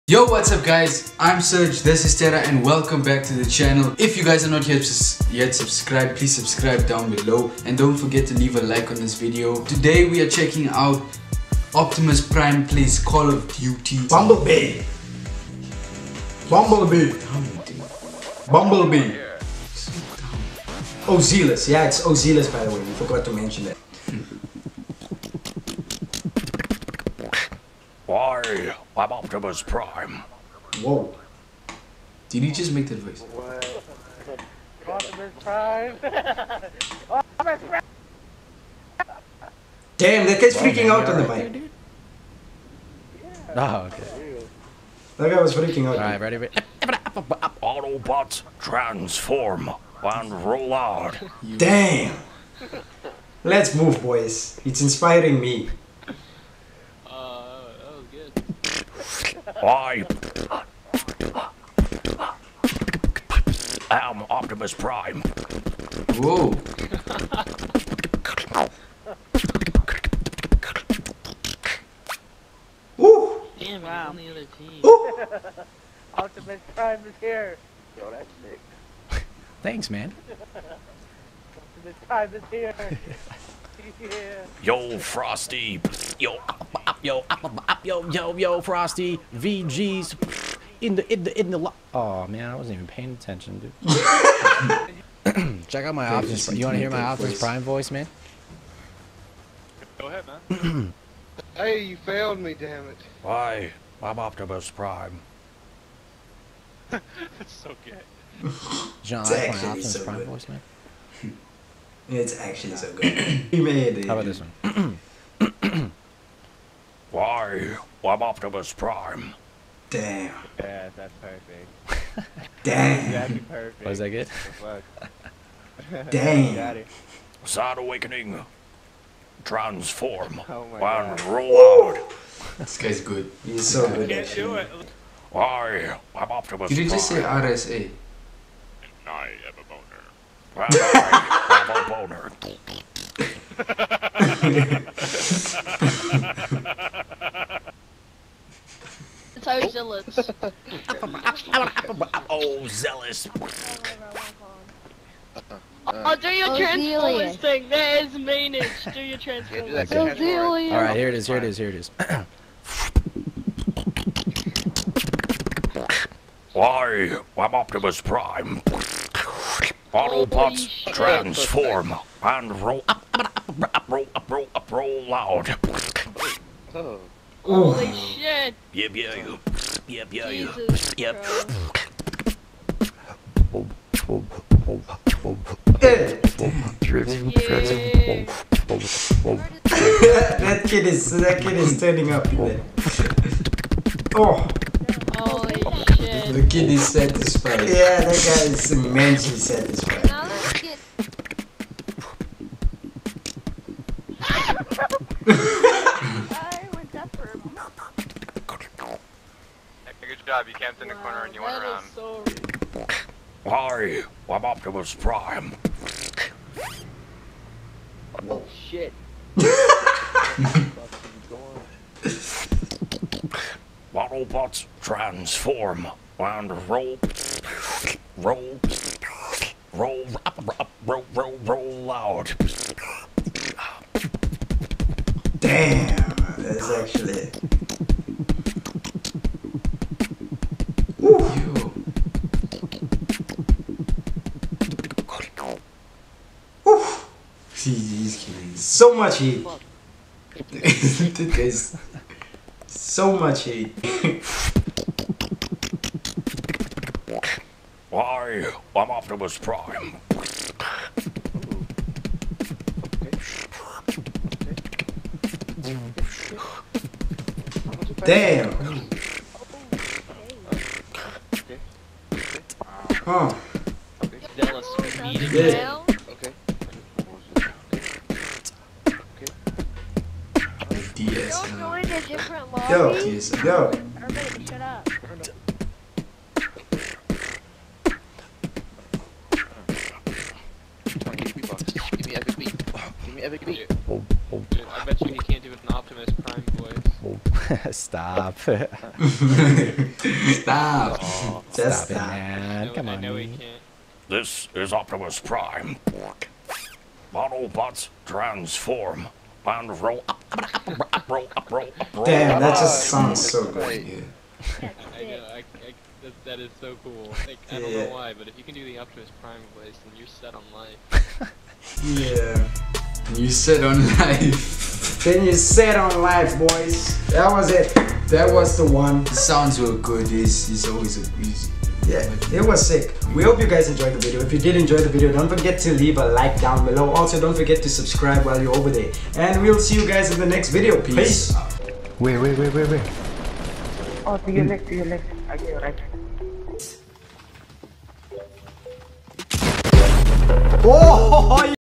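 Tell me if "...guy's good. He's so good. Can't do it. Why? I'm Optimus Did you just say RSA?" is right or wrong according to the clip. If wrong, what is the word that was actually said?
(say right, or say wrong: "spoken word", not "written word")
right.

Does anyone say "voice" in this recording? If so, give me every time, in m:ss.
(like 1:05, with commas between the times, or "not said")
0:32, 1:37, 1:50, 5:19.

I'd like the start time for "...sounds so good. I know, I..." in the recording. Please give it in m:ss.
5:12.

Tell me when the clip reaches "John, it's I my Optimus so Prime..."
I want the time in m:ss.
1:49.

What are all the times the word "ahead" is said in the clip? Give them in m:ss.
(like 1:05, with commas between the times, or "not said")
1:40.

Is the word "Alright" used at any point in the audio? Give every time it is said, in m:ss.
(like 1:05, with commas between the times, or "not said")
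0:45.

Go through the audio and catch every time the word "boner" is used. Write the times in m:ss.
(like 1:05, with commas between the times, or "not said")
2:20, 2:24.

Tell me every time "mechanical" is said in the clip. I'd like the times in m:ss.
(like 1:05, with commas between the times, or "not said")
not said.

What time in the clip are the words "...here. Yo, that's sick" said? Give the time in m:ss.
1:17.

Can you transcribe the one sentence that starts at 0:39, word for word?
Damn, that guy's freaking out on the mic.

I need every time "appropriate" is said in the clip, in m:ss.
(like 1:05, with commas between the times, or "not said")
not said.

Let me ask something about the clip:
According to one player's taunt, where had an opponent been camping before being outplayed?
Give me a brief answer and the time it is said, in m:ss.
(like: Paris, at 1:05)
In the corner, at 3:30.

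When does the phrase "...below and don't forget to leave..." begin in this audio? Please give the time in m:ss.
0:07.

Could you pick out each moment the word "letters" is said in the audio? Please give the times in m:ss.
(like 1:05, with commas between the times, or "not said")
not said.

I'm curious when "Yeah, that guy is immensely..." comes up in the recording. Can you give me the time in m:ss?
3:17.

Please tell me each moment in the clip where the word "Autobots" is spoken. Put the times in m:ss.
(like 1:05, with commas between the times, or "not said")
0:46, 2:49, 3:43.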